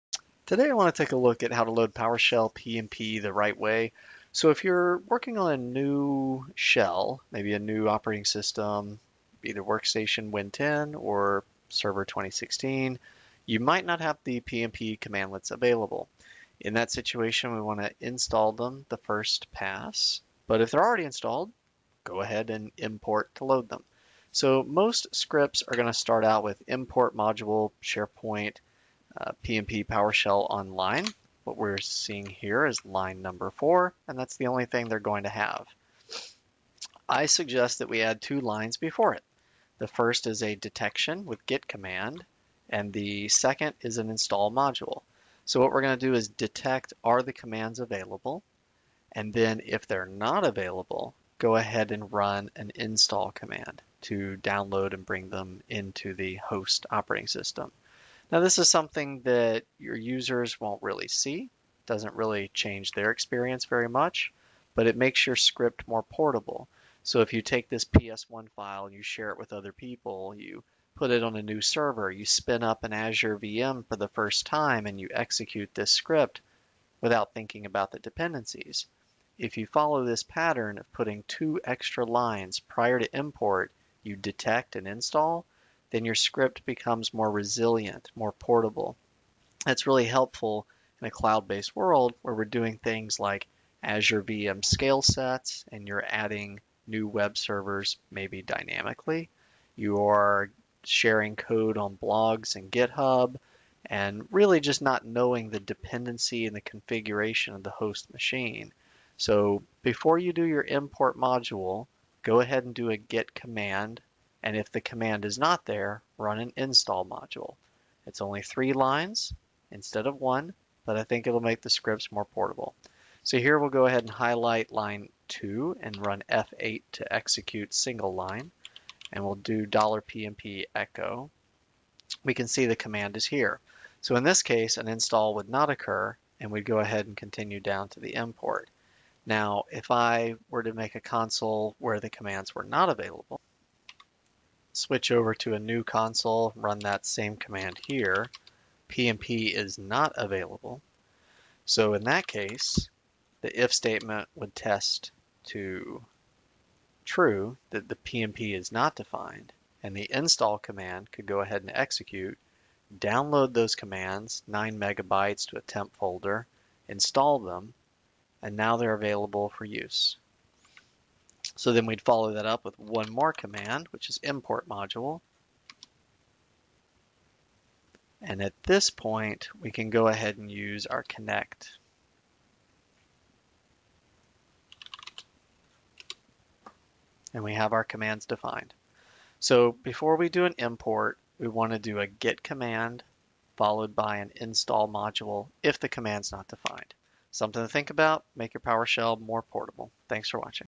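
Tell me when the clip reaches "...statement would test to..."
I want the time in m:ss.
2:33.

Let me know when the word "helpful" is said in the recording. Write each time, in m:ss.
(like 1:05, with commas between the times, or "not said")
1:30.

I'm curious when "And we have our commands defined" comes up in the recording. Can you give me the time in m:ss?
3:07.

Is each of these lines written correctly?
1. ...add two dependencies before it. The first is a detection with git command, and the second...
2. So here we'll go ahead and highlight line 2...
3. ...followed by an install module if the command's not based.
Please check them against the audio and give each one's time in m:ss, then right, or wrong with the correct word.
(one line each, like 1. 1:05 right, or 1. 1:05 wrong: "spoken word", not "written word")
1. 0:38 wrong: "lines", not "dependencies"
2. 2:03 right
3. 3:13 wrong: "defined", not "based".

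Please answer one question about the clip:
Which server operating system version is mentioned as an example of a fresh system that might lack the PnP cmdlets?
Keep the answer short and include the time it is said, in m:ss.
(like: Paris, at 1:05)
Server 2016, at 0:11.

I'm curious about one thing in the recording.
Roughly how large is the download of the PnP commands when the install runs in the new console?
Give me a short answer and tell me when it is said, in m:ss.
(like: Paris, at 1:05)
9 megabytes, at 2:44.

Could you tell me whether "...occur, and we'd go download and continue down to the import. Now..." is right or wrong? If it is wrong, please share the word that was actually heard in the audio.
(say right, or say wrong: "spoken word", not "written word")
wrong: "ahead", not "download".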